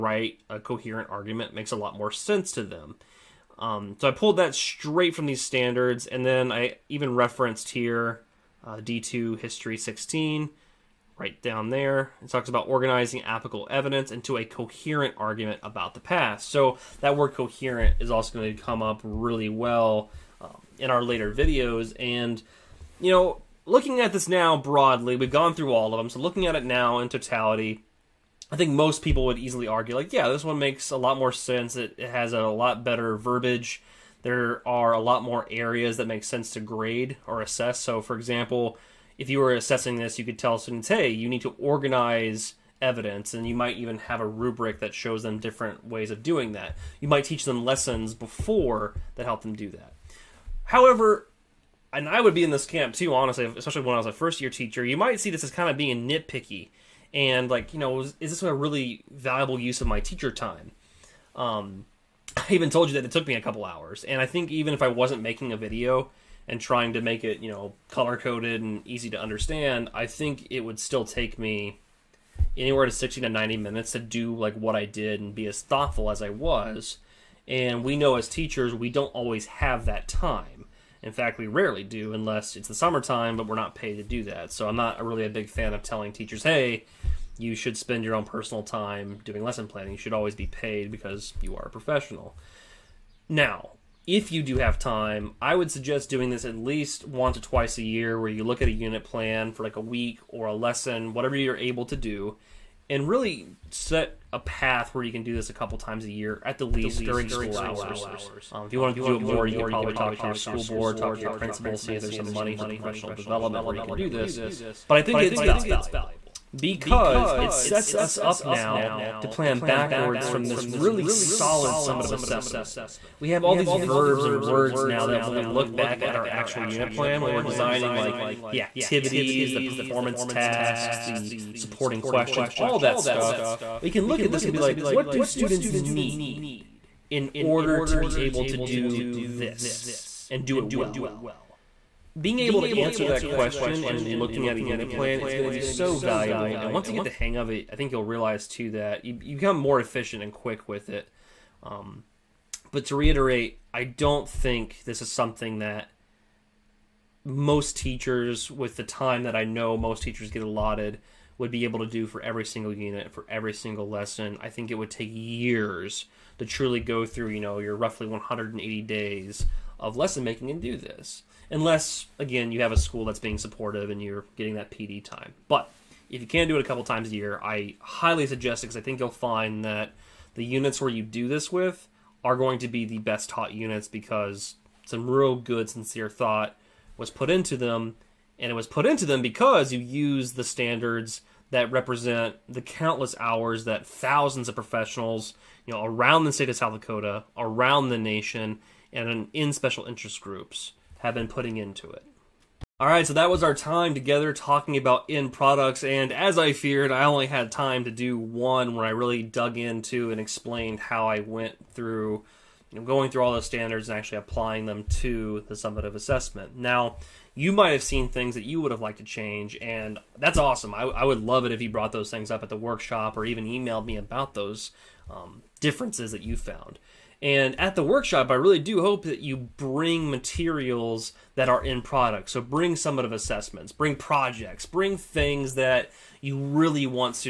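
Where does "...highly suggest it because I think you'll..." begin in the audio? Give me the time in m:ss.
2:57.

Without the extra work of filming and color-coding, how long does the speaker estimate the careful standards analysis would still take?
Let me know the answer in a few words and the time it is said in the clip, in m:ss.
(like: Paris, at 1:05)
60 to 90 minutes, at 1:12.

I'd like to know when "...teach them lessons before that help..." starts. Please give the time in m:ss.
0:47.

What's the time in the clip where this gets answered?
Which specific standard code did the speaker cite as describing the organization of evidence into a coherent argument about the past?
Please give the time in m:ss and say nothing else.
0:08.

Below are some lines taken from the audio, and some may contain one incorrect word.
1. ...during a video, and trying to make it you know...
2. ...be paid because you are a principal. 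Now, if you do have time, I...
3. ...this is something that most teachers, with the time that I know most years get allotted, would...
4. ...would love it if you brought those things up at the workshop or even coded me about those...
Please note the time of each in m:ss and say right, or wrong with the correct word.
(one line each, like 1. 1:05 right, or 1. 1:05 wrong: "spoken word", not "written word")
1. 1:05 wrong: "making", not "during"
2. 1:30 wrong: "professional", not "principal"
3. 2:34 wrong: "teachers", not "years"
4. 3:41 wrong: "emailed", not "coded".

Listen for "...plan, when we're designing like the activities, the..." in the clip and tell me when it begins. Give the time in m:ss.
2:06.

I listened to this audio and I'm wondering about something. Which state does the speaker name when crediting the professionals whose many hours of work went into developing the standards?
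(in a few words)
South Dakota.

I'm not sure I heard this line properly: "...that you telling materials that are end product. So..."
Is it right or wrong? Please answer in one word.
wrong.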